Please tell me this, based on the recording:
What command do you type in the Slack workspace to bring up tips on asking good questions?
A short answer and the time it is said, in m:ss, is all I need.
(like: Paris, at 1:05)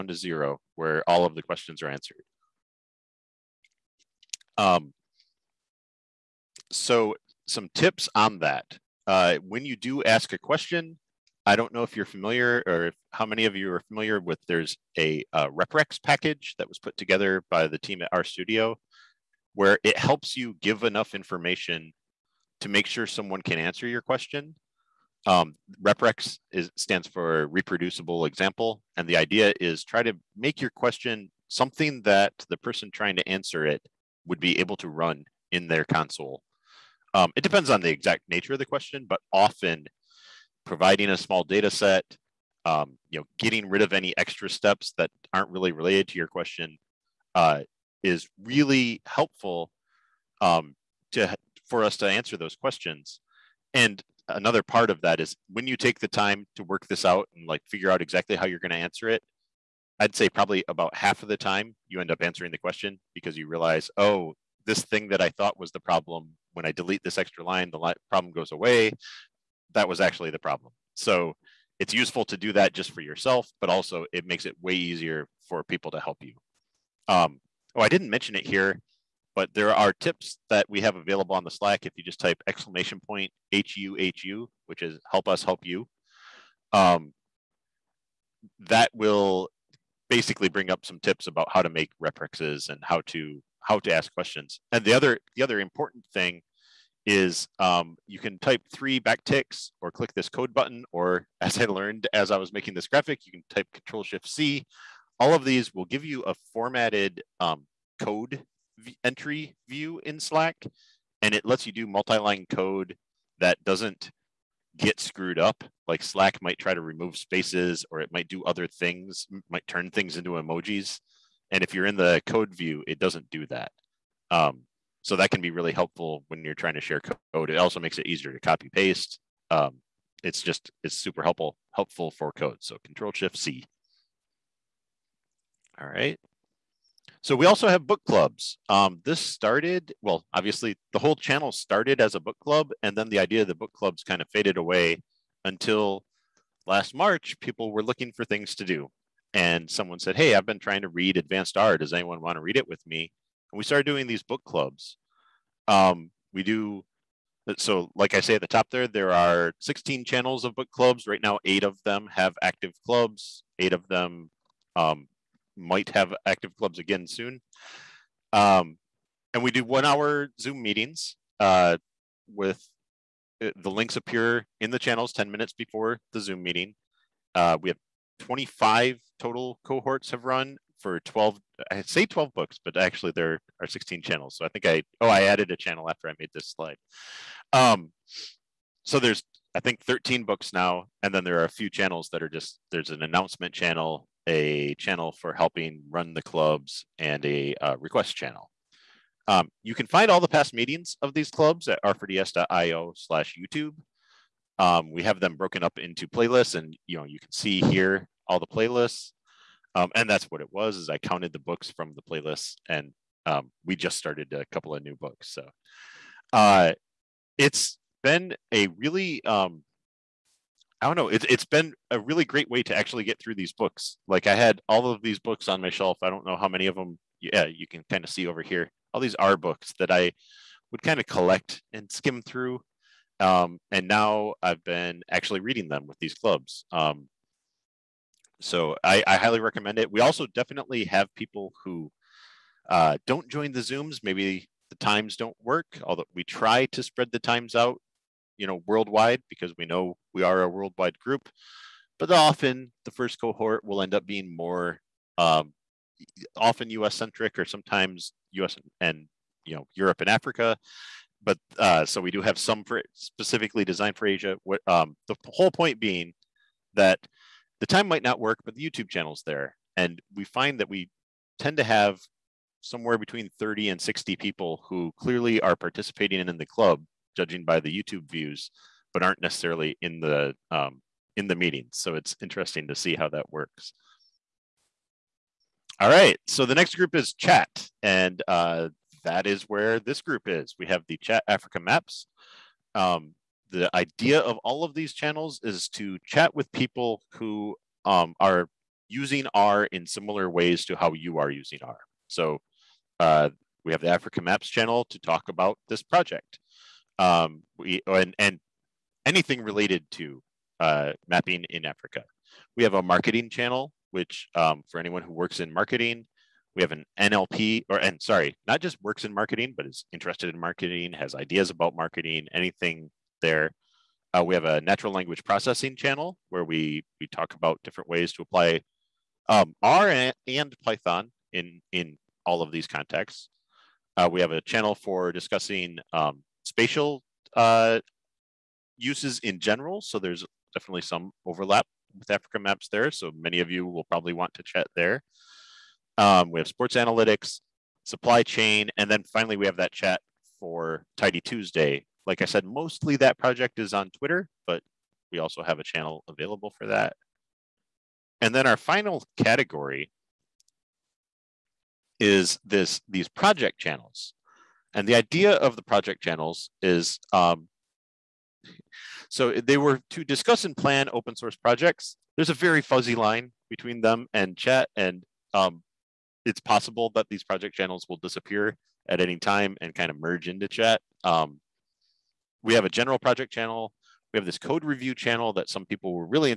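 !HUHU, at 1:22.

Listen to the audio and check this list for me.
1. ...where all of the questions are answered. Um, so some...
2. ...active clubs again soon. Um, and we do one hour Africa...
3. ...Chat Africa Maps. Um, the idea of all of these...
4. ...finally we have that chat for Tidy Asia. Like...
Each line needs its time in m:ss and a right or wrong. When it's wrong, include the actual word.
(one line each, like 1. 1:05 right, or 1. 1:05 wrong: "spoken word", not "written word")
1. 0:00 right
2. 2:46 wrong: "Zoom", not "Africa"
3. 4:50 right
4. 5:49 wrong: "Tuesday", not "Asia".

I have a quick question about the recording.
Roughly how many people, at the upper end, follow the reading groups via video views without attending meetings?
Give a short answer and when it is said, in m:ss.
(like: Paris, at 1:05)
60, at 4:33.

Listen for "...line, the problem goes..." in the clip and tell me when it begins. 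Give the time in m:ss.
1:07.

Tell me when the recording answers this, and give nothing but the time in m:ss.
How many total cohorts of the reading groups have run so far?
2:58.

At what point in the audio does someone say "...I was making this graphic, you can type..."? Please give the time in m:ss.
1:42.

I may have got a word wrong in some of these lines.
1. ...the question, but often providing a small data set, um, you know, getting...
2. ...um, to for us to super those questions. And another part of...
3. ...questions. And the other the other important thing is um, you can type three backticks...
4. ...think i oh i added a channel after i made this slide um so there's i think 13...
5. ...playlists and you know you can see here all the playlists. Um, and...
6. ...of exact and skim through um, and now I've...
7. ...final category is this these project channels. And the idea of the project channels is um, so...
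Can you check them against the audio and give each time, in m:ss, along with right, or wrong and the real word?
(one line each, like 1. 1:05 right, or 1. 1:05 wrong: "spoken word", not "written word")
1. 0:38 right
2. 0:50 wrong: "answer", not "super"
3. 1:34 right
4. 3:04 right
5. 3:26 right
6. 3:50 wrong: "collect", not "exact"
7. 5:58 right.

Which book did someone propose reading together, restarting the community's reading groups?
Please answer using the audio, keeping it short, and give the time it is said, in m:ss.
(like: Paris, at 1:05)
Advanced R, at 2:31.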